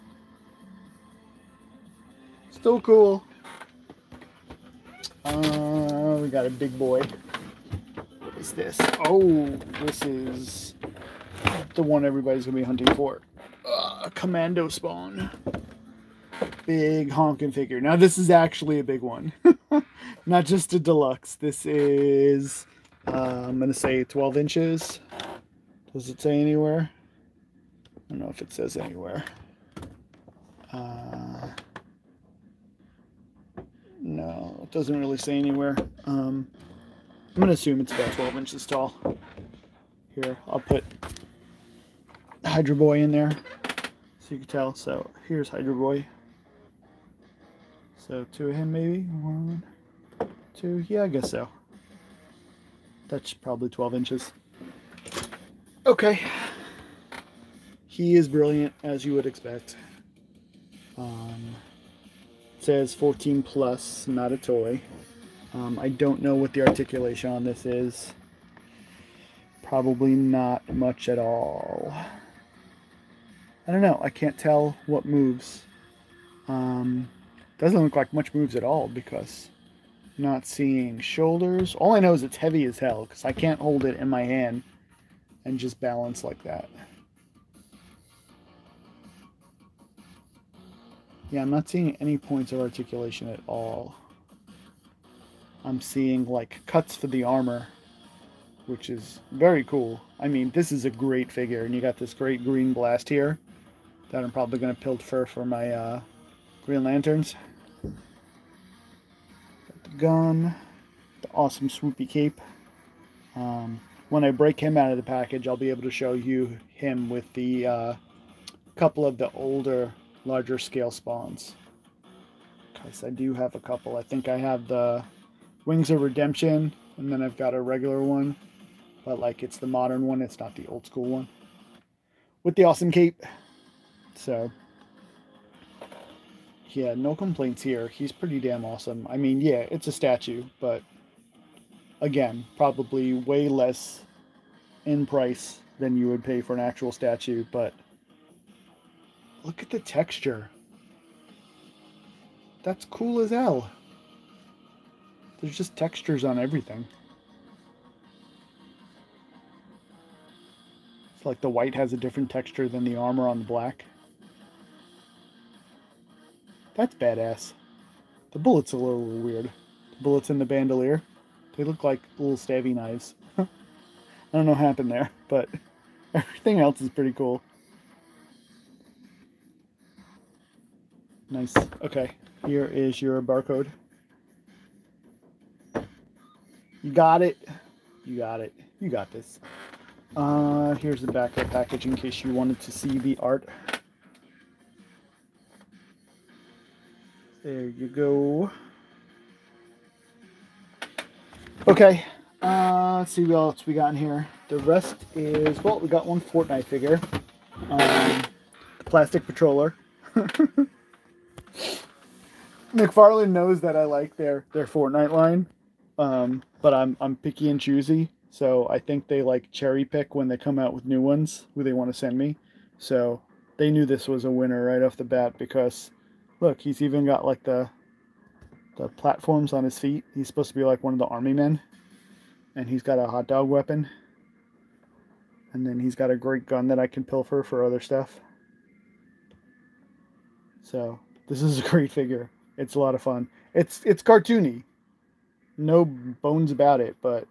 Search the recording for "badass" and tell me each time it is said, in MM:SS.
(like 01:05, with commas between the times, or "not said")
02:46.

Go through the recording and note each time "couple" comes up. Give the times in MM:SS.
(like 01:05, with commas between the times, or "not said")
01:58, 02:03.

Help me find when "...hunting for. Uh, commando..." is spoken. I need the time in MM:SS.
00:12.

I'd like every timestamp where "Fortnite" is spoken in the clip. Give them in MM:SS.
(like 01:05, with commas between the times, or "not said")
03:26, 03:34.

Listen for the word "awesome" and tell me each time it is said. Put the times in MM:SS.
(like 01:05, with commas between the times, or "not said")
01:51, 02:12, 02:18.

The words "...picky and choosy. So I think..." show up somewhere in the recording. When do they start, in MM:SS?
03:37.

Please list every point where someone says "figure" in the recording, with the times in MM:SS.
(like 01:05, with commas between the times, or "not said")
00:17, 01:41, 03:26, 04:01.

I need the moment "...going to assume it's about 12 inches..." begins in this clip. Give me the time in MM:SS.
00:37.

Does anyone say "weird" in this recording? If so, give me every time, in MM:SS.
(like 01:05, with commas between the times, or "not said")
02:49.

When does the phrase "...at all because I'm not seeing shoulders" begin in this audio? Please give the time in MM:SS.
01:18.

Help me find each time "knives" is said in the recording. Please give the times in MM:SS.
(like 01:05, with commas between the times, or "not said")
02:52.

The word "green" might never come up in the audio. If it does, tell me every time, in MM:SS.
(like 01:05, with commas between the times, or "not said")
01:42, 01:46.